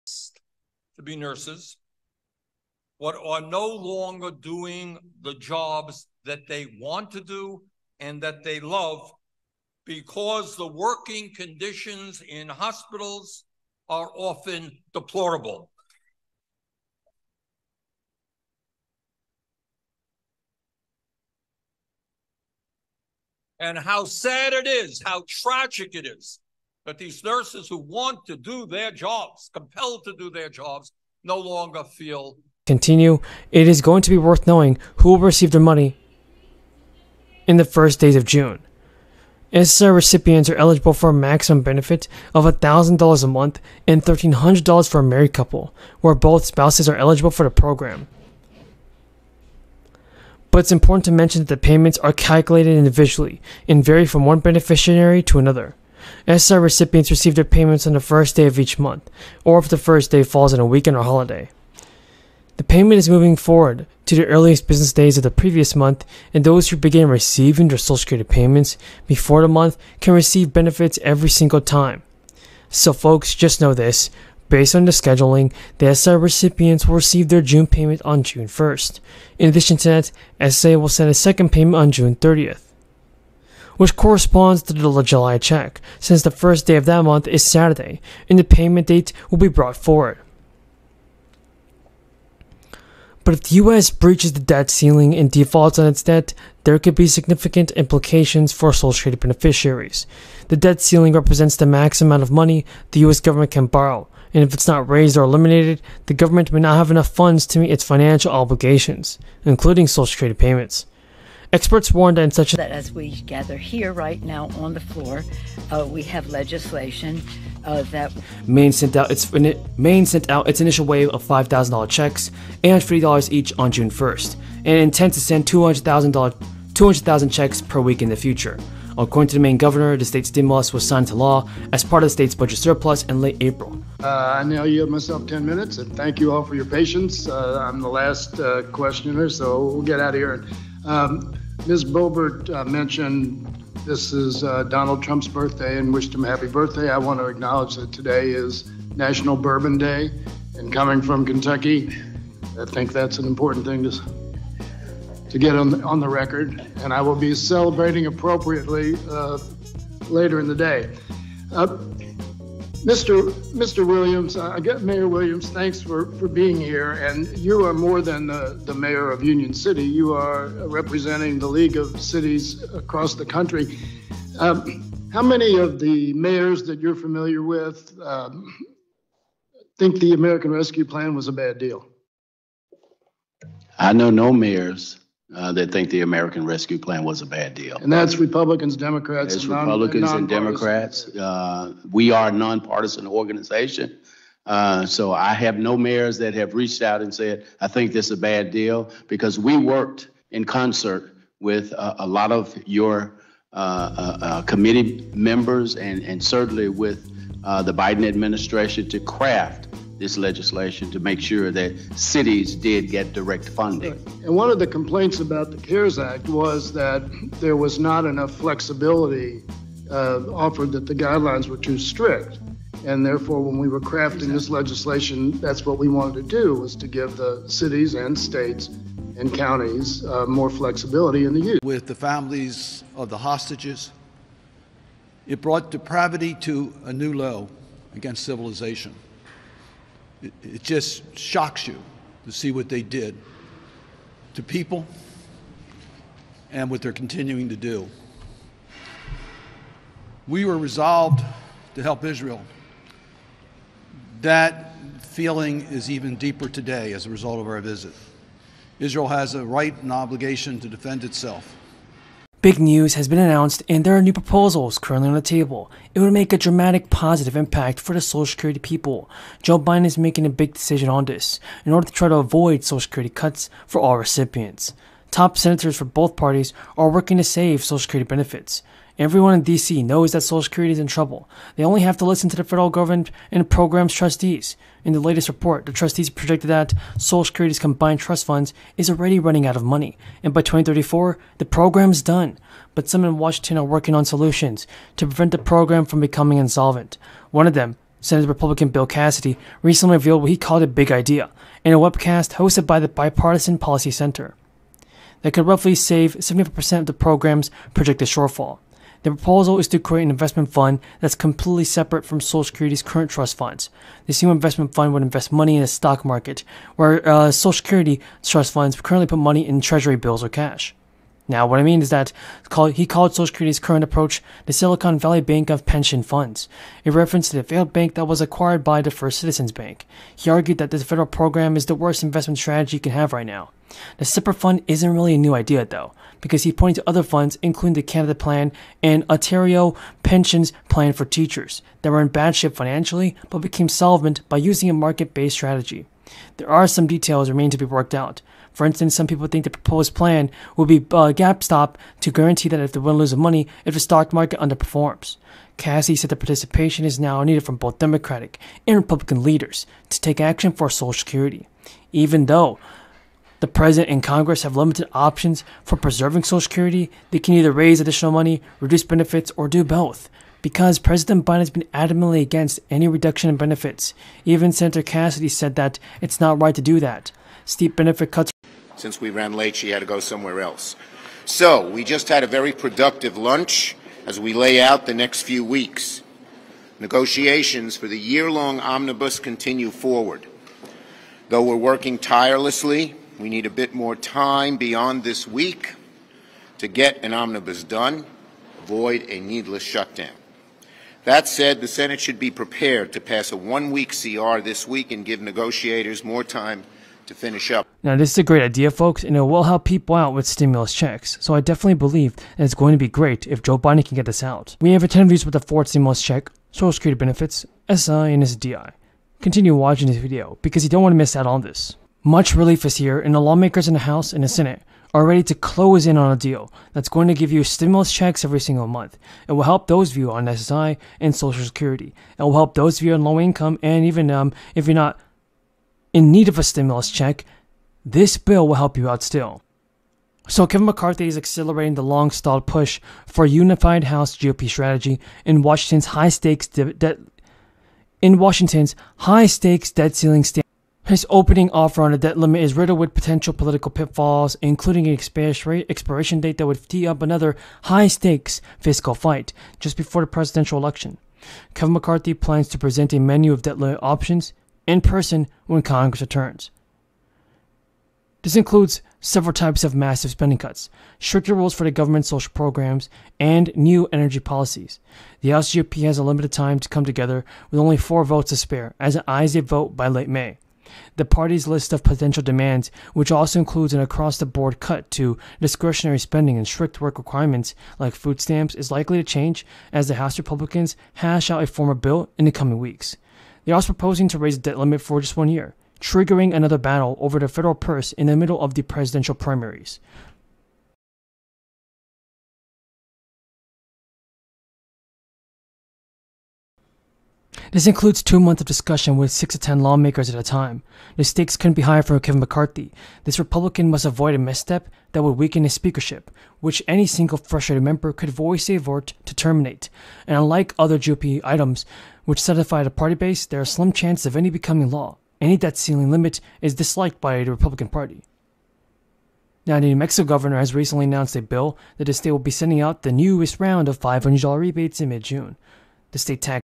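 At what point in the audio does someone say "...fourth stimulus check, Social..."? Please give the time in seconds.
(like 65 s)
415 s.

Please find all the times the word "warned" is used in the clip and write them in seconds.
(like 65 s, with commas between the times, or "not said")
111 s.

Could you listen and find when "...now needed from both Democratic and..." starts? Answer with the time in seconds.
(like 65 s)
356 s.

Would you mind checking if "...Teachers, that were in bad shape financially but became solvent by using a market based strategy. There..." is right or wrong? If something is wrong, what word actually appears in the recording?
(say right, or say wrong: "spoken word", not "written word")
right.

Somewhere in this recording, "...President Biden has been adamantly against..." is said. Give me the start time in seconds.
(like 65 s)
370 s.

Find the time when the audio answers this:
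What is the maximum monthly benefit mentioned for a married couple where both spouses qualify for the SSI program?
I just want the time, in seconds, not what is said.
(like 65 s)
44 s.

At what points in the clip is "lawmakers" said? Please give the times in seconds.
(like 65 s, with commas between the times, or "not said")
423 s, 509 s.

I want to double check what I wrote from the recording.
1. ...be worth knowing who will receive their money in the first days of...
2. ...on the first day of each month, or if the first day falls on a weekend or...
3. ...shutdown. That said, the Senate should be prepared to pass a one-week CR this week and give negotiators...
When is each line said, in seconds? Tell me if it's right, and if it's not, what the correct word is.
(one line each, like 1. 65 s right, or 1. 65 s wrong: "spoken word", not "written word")
1. 34 s right
2. 57 s right
3. 399 s right.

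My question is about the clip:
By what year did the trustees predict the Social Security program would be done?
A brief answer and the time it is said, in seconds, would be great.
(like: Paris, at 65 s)
2034, at 290 s.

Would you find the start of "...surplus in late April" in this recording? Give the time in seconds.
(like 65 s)
132 s.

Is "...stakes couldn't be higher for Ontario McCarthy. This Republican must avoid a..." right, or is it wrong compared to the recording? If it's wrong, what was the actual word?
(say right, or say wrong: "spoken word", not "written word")
wrong: "Kevin", not "Ontario".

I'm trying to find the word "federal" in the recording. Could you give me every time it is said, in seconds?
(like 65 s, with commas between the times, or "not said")
282 s, 330 s, 497 s.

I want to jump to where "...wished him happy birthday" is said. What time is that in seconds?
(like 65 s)
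145 s.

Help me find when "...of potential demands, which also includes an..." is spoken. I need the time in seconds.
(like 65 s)
481 s.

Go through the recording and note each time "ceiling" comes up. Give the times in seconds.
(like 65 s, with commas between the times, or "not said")
94 s, 100 s, 449 s, 525 s.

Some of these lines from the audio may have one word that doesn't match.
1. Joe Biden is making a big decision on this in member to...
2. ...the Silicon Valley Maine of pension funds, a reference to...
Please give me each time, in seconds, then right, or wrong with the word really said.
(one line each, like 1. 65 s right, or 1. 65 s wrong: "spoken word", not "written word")
1. 269 s wrong: "order", not "member"
2. 324 s wrong: "Bank", not "Maine".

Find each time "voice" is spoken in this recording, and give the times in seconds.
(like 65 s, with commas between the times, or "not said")
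518 s.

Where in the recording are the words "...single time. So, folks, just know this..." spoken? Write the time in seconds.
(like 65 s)
71 s.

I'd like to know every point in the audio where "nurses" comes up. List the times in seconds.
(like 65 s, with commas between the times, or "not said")
1 s, 27 s.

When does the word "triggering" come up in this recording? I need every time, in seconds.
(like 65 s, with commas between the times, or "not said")
495 s.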